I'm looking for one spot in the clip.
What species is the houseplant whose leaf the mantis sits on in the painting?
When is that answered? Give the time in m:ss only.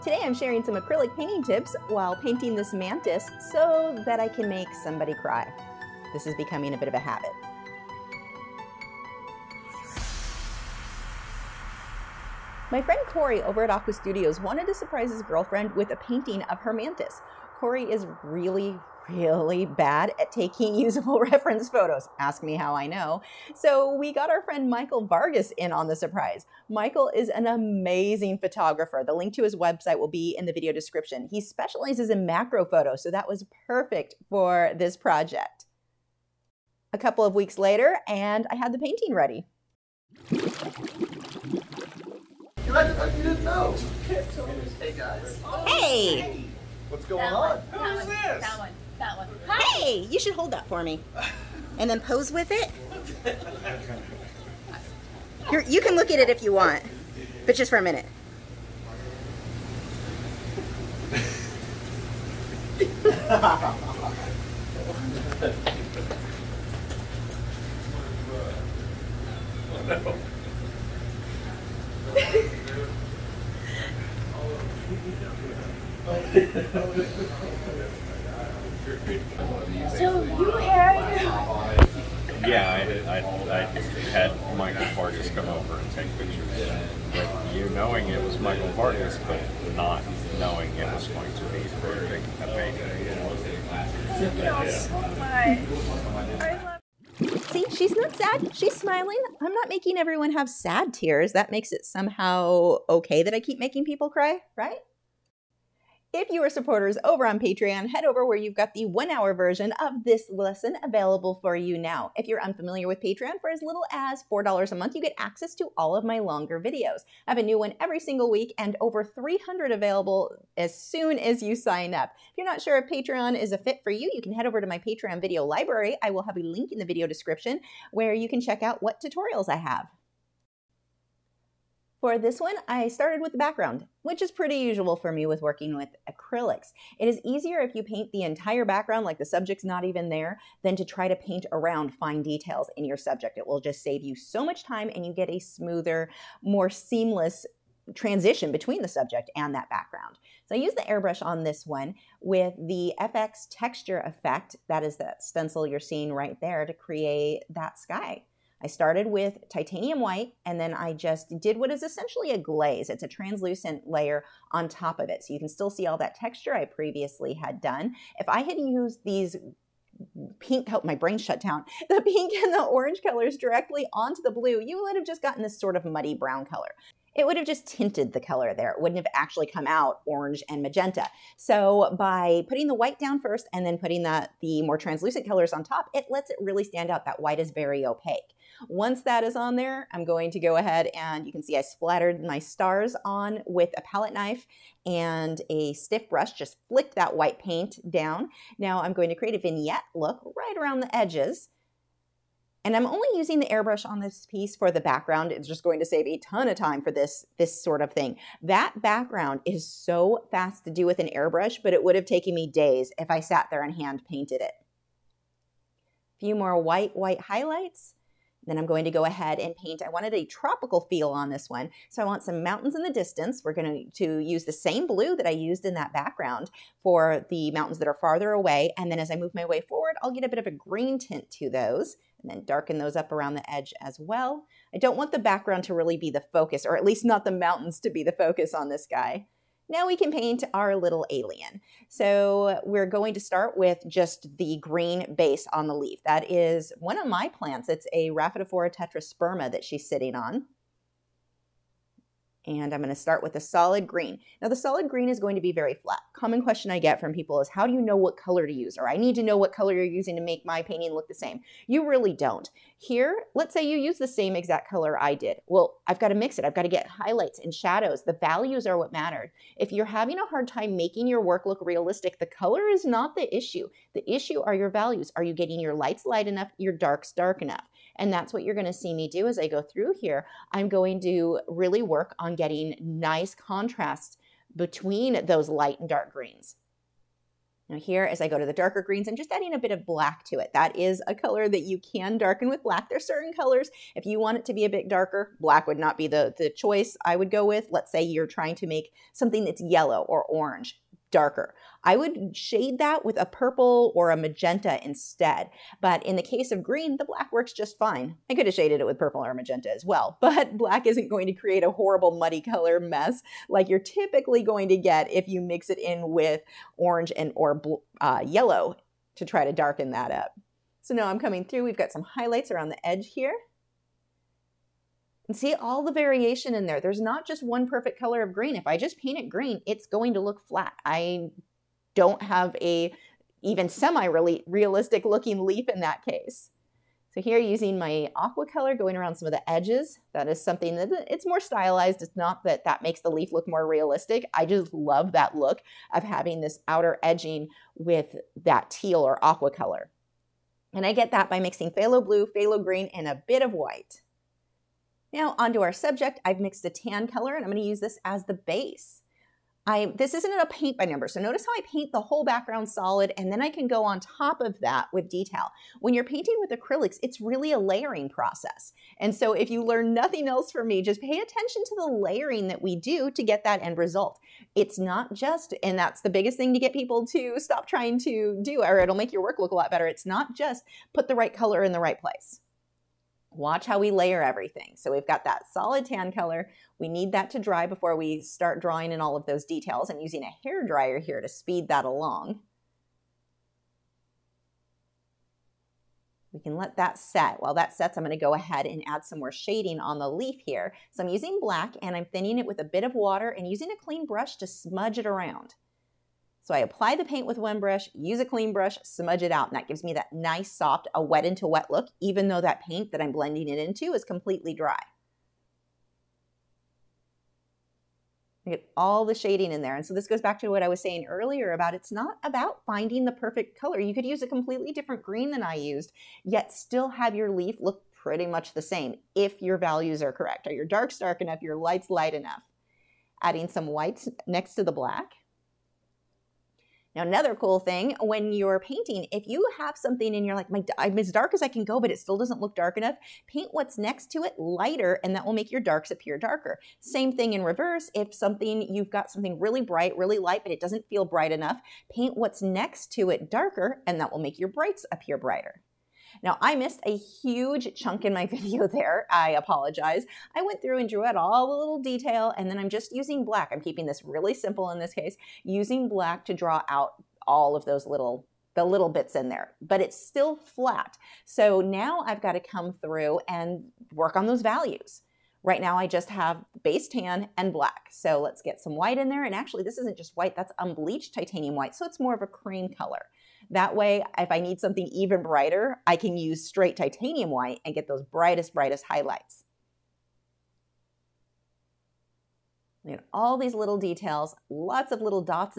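4:08.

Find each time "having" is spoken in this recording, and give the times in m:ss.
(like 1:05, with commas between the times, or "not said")
4:29, 5:46.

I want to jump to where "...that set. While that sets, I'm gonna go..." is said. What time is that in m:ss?
6:36.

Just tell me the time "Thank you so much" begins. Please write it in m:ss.
1:34.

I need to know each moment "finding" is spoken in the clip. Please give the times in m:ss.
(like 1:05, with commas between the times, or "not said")
7:02.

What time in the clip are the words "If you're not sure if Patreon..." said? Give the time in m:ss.
2:02.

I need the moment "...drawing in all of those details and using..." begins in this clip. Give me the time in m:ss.
6:28.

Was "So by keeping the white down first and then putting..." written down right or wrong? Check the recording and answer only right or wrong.
wrong.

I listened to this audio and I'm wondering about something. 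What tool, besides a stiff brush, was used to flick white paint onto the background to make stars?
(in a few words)
palette knife.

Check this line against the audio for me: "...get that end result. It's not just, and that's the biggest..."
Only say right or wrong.
right.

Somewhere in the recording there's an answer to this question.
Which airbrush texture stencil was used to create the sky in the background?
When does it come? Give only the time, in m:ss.
2:32.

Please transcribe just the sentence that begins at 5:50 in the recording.
And I get that by mixing phthalo blue, phthalo green, and a bit of white.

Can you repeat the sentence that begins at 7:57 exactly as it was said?
So let's get some white in there.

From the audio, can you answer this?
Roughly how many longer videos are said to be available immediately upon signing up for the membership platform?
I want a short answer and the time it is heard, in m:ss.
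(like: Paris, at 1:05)
300, at 1:58.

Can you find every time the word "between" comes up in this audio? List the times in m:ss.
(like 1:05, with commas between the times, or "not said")
2:28, 4:44.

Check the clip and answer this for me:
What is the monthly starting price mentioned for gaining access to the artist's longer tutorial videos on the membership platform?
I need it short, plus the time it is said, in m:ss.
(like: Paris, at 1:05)
$4, at 1:54.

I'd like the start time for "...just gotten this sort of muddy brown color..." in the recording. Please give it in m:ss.
2:55.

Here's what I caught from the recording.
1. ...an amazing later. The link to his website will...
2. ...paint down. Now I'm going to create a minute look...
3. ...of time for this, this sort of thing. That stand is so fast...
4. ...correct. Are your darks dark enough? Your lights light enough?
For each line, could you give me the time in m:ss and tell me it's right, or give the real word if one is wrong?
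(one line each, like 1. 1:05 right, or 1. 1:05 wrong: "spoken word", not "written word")
1. 0:27 wrong: "photographer", not "later"
2. 3:17 wrong: "vignette", not "minute"
3. 3:26 wrong: "background", not "stand"
4. 7:10 right.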